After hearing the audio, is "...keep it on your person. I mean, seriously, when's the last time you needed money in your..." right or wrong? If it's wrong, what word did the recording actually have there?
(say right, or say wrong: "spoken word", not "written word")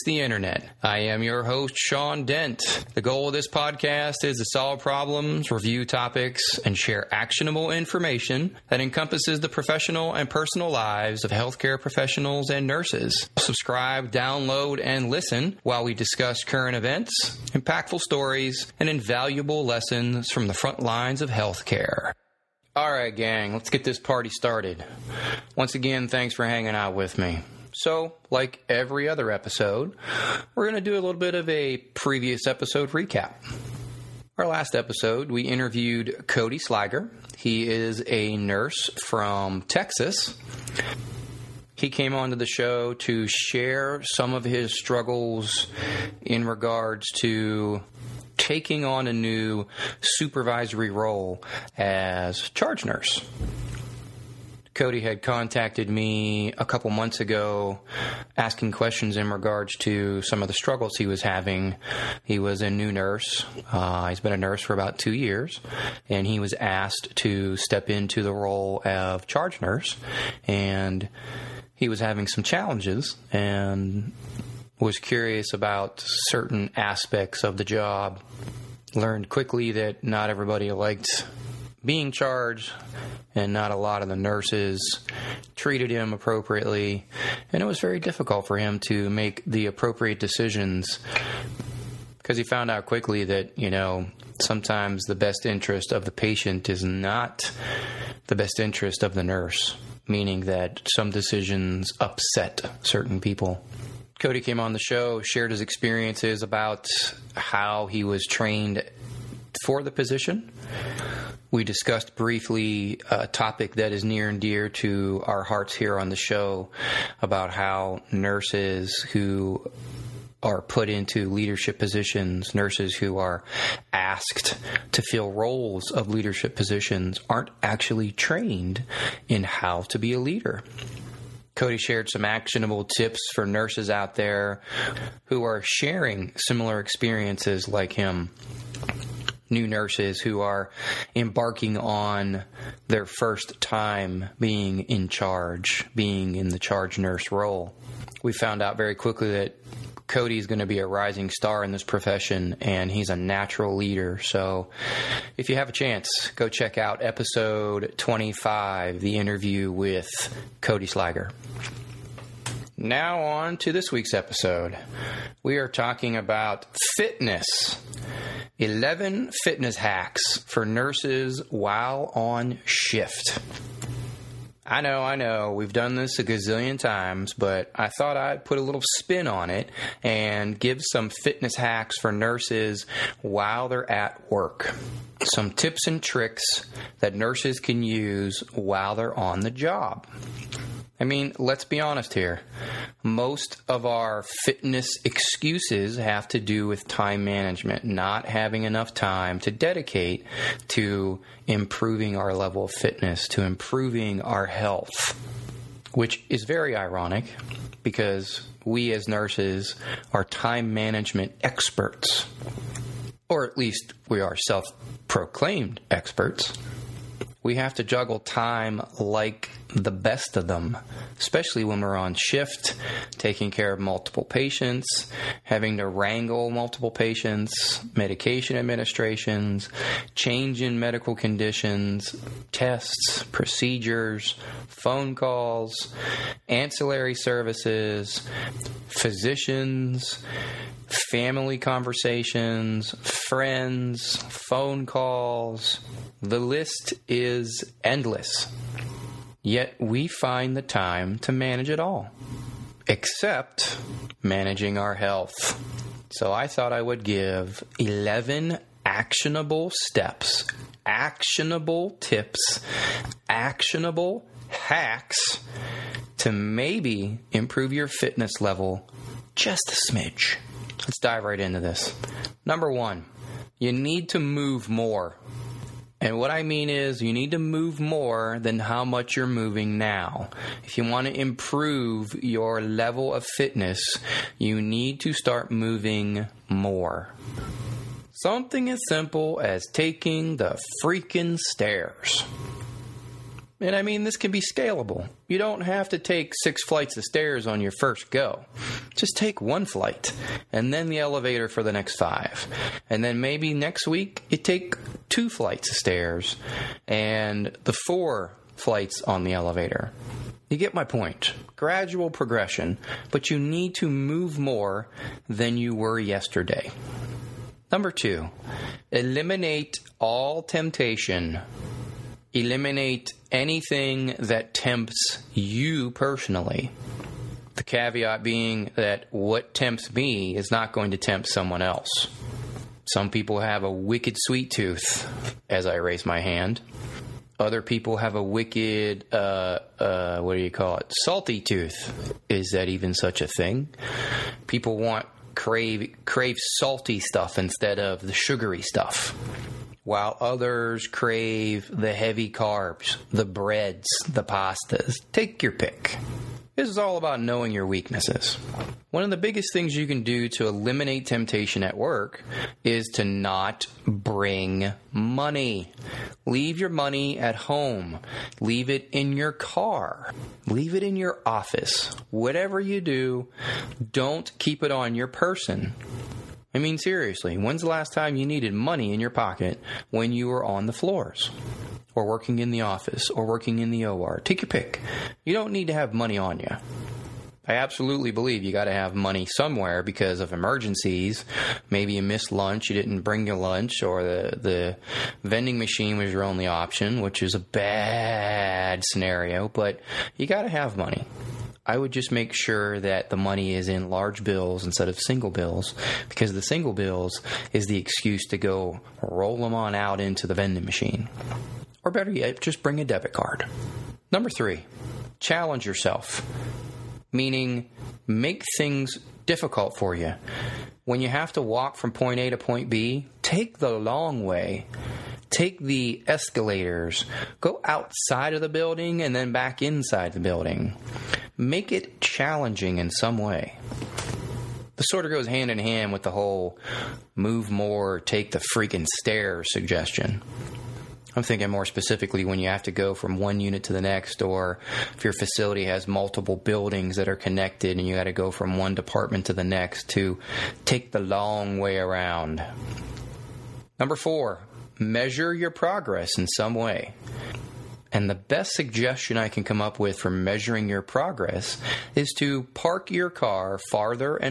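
right.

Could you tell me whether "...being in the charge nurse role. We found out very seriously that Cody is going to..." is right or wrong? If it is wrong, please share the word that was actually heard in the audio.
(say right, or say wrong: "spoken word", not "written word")
wrong: "quickly", not "seriously".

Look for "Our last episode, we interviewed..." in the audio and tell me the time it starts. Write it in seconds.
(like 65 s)
34 s.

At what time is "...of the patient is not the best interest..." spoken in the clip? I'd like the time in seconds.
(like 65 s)
95 s.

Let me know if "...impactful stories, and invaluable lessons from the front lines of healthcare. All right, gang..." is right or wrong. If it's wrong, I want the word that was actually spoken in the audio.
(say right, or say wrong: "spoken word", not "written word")
right.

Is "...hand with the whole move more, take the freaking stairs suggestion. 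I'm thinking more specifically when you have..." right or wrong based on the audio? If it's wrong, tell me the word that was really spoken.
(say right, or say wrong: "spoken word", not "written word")
right.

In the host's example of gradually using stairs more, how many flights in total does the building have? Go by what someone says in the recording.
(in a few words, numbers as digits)
6.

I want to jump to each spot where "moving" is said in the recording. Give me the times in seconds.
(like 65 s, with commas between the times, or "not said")
279 s, 285 s.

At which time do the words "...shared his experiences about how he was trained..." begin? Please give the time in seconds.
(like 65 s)
105 s.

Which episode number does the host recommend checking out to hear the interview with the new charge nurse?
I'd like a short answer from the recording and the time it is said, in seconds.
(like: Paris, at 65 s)
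25, at 157 s.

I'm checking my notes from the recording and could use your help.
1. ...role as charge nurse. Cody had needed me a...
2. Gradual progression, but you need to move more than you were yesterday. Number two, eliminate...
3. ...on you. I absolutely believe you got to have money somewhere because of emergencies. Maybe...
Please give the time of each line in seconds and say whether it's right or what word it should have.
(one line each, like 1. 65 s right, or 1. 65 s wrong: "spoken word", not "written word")
1. 50 s wrong: "contacted", not "needed"
2. 311 s right
3. 386 s right.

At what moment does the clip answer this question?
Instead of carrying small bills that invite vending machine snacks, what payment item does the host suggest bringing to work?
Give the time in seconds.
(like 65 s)
412 s.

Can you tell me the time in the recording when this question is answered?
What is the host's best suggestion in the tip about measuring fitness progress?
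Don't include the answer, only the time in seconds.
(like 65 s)
462 s.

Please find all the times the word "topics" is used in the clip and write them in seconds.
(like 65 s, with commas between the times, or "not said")
5 s, 113 s.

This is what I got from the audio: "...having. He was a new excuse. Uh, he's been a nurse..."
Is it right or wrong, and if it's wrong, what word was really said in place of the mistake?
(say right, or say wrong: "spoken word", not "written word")
wrong: "nurse", not "excuse".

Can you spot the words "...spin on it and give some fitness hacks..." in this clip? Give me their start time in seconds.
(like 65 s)
178 s.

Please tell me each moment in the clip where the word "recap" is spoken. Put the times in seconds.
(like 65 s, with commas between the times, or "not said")
32 s.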